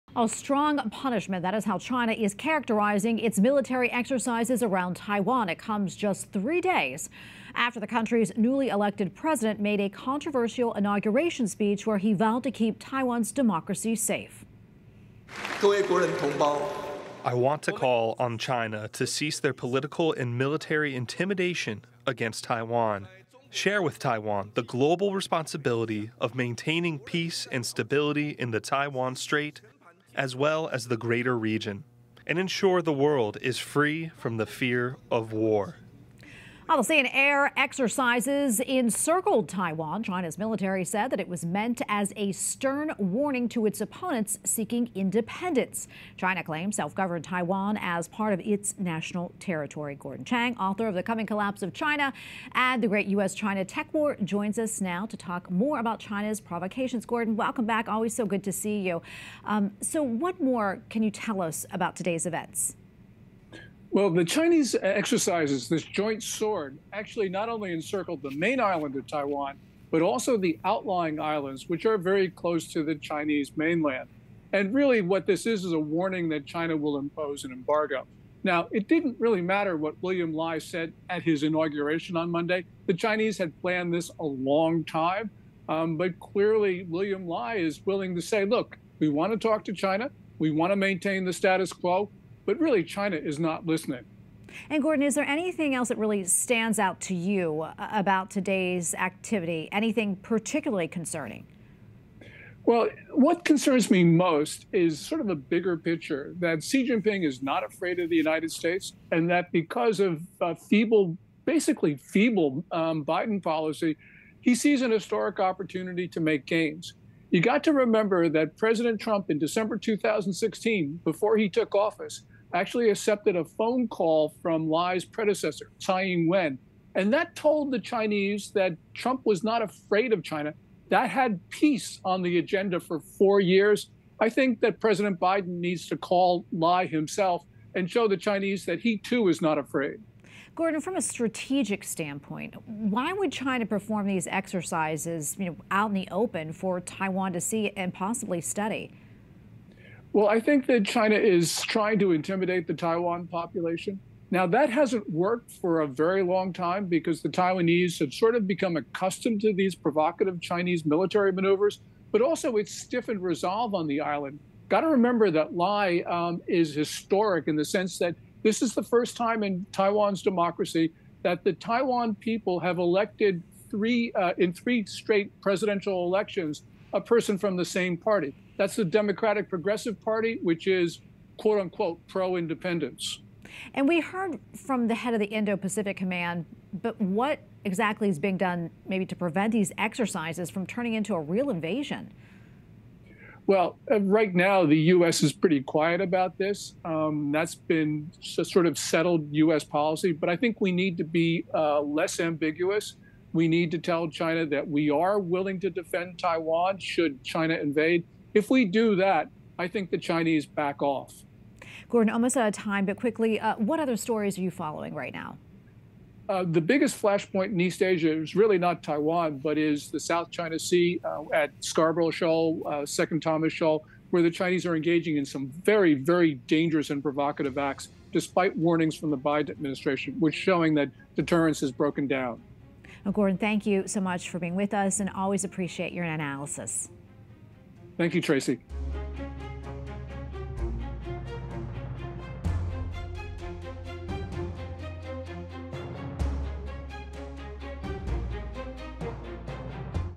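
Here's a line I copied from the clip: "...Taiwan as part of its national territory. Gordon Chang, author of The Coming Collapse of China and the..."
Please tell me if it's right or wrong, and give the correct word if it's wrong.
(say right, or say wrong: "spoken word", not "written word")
right.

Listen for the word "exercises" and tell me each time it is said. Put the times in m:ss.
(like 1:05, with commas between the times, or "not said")
0:03, 0:37, 1:04, 2:24, 3:09.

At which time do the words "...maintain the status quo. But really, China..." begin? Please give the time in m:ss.
1:30.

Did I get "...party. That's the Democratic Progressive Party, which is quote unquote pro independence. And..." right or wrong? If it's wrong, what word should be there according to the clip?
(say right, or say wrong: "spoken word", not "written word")
right.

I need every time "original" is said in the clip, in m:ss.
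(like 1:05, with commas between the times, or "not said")
not said.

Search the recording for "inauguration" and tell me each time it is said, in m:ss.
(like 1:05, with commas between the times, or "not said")
0:10, 1:21.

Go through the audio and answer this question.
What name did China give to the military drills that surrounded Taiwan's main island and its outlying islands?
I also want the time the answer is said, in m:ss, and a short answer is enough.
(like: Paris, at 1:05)
Joint Sword, at 1:05.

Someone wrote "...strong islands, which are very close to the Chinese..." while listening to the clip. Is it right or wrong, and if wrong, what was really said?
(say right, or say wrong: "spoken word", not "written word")
wrong: "outlying", not "strong".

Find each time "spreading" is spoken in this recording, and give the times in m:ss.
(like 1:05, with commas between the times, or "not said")
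not said.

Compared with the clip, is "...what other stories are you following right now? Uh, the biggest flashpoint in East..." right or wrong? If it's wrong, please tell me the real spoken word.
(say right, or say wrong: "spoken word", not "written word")
right.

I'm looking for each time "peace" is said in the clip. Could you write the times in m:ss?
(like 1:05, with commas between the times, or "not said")
0:26, 2:11.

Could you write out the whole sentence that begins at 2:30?
Well, I think that China is trying to intimidate the Taiwan population.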